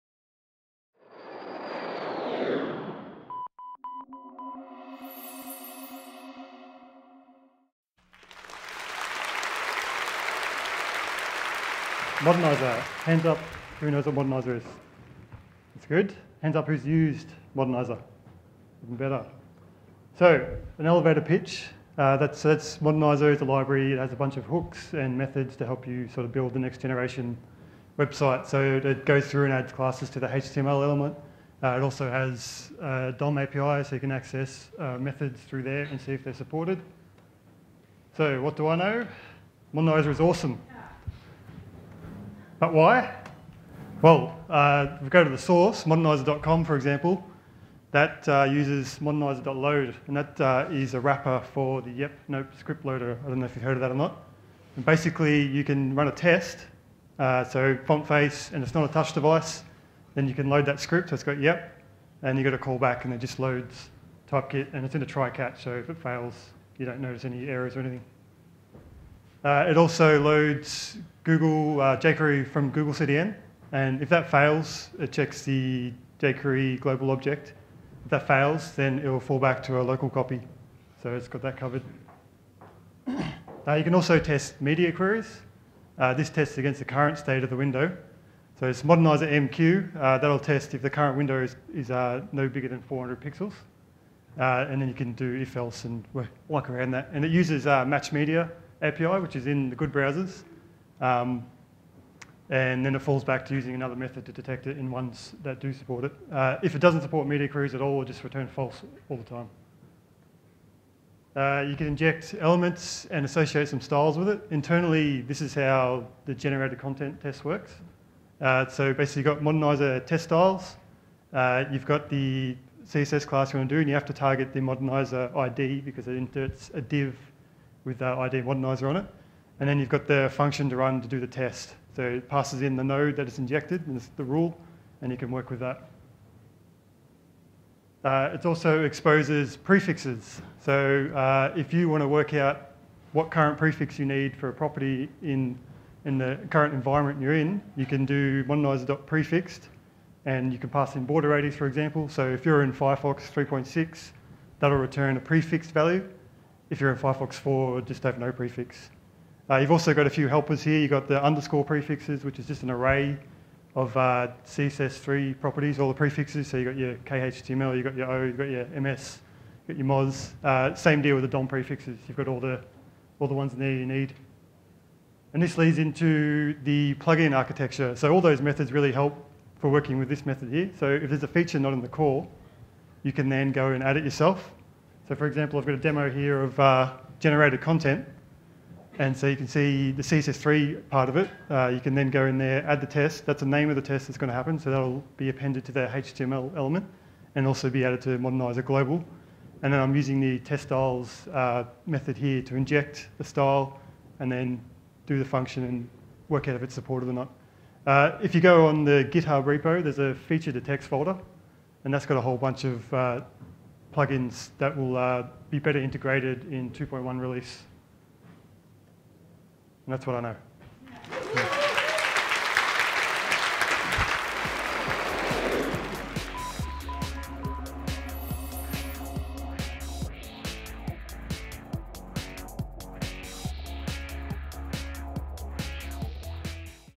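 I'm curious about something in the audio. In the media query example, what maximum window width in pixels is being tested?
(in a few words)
400.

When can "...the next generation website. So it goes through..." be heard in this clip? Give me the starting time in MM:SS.
00:26.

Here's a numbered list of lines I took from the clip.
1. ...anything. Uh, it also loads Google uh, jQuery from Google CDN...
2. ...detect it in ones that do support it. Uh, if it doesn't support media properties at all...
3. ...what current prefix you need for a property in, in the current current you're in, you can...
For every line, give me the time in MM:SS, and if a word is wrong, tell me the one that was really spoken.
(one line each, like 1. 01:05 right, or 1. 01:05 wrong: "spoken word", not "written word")
1. 01:07 right
2. 01:44 wrong: "queries", not "properties"
3. 02:23 wrong: "environment", not "current".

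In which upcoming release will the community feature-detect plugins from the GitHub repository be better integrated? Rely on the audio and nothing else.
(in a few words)
2.1.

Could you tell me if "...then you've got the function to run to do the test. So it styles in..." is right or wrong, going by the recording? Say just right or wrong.
wrong.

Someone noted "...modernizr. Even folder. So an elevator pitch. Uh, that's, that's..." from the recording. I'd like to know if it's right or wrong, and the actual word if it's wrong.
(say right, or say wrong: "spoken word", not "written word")
wrong: "better", not "folder".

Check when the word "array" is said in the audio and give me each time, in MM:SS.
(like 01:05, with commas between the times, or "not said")
02:42.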